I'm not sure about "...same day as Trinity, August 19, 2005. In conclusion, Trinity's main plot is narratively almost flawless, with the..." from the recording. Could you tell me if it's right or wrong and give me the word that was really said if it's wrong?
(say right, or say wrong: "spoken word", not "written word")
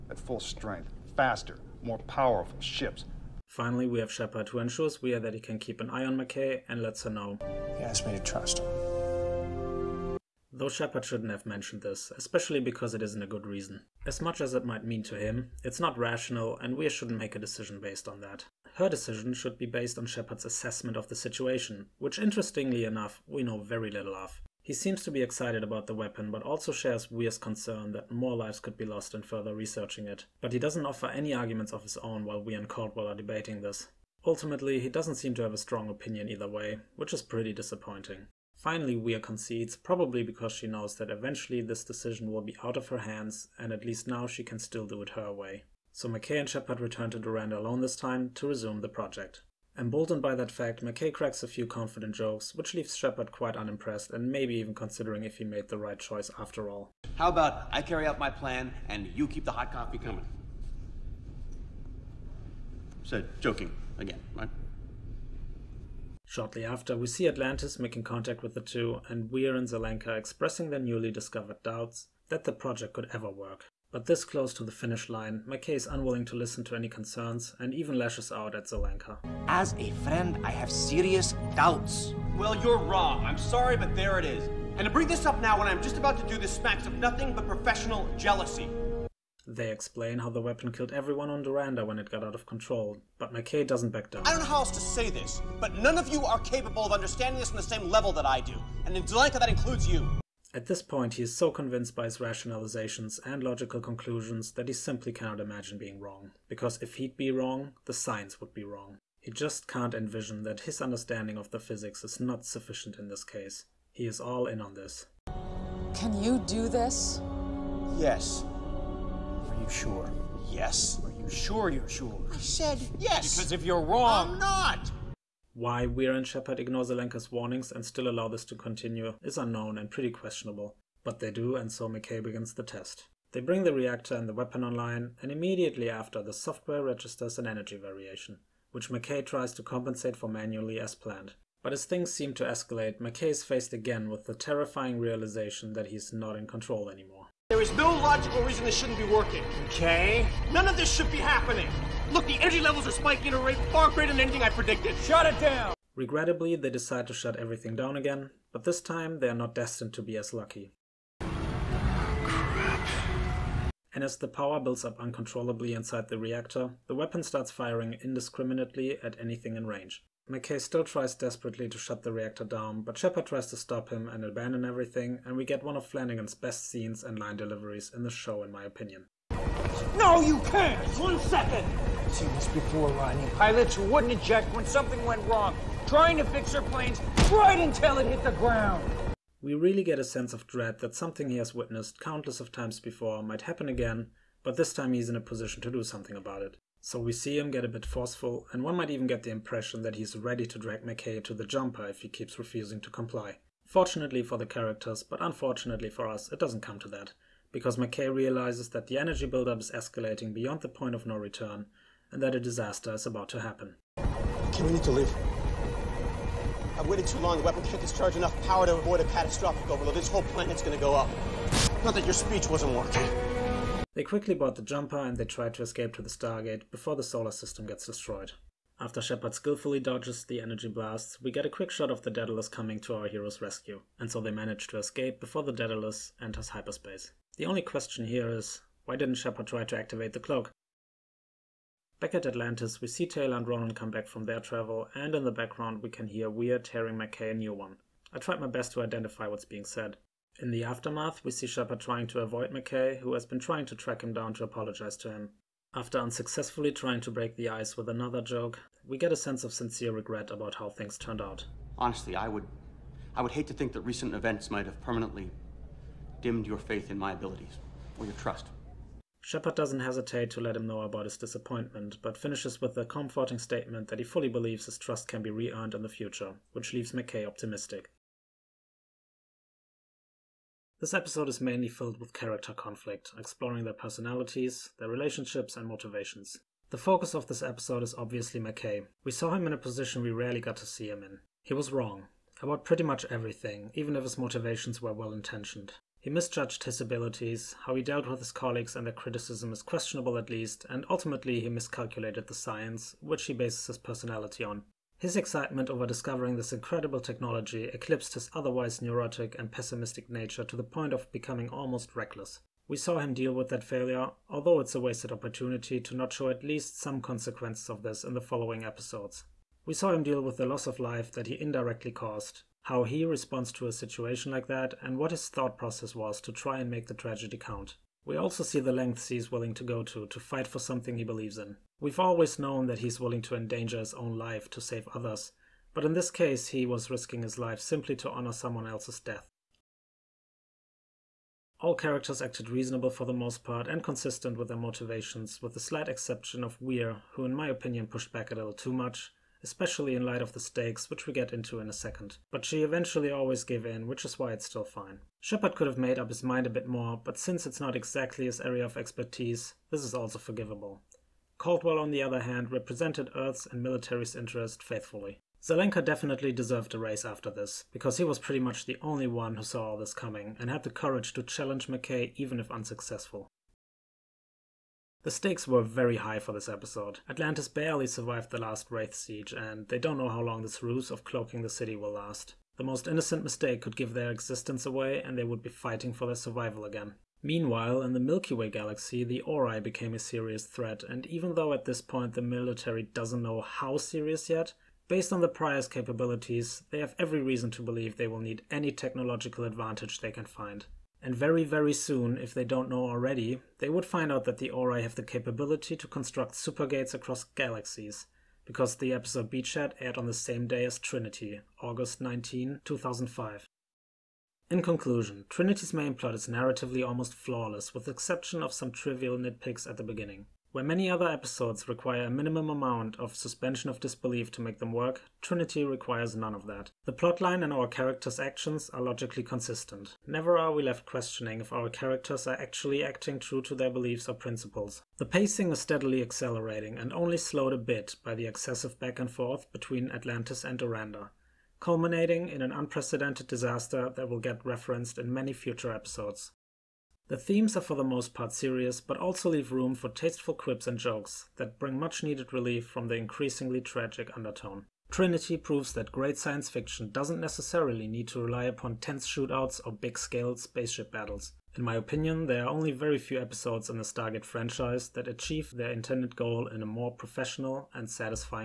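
right.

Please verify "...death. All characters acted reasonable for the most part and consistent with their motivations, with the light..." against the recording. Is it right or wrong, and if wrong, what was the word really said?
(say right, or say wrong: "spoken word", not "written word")
wrong: "slight", not "light".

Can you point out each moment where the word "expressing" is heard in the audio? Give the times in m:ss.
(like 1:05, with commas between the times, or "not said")
1:10.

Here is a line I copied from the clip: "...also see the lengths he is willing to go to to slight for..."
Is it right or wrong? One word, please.
wrong.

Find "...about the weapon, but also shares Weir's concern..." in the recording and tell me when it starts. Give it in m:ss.
0:25.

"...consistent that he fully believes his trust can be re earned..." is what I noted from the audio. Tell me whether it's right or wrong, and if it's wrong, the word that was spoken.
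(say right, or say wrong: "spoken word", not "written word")
wrong: "statement", not "consistent".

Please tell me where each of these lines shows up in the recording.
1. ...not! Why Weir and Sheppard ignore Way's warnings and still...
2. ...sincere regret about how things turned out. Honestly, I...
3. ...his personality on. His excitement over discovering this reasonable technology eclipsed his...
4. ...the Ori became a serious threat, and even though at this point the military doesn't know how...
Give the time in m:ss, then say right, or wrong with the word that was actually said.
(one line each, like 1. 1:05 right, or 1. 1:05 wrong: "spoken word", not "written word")
1. 2:04 wrong: "Zelenka", not "Way"
2. 4:19 right
3. 5:03 wrong: "incredible", not "reasonable"
4. 6:29 right.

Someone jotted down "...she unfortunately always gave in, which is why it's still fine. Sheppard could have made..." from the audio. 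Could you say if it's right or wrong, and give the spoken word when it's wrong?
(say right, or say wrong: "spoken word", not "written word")
wrong: "eventually", not "unfortunately".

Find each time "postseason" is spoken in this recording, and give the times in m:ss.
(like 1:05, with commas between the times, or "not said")
not said.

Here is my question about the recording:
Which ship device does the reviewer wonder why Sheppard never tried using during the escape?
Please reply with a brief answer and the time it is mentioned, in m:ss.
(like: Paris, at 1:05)
the cloak, at 4:00.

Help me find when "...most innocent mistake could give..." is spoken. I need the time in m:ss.
6:22.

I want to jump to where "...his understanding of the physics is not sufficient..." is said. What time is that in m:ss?
1:50.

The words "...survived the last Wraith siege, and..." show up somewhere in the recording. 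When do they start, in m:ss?
6:17.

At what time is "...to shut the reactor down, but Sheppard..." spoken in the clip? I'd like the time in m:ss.
2:51.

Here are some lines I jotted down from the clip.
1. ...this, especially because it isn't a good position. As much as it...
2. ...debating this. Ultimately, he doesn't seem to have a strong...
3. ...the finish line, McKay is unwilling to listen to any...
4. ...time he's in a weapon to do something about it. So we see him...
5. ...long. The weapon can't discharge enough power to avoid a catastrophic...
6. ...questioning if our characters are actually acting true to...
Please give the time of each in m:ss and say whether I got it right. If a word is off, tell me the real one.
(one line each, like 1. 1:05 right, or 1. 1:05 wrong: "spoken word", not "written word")
1. 0:11 wrong: "reason", not "position"
2. 0:33 right
3. 1:14 right
4. 3:14 wrong: "position", not "weapon"
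5. 3:37 right
6. 7:10 right.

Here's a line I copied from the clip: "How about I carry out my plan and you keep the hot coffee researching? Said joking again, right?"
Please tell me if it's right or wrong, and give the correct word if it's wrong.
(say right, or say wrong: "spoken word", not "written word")
wrong: "coming", not "researching".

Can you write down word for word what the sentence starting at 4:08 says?
I tried my best to identify what's being said.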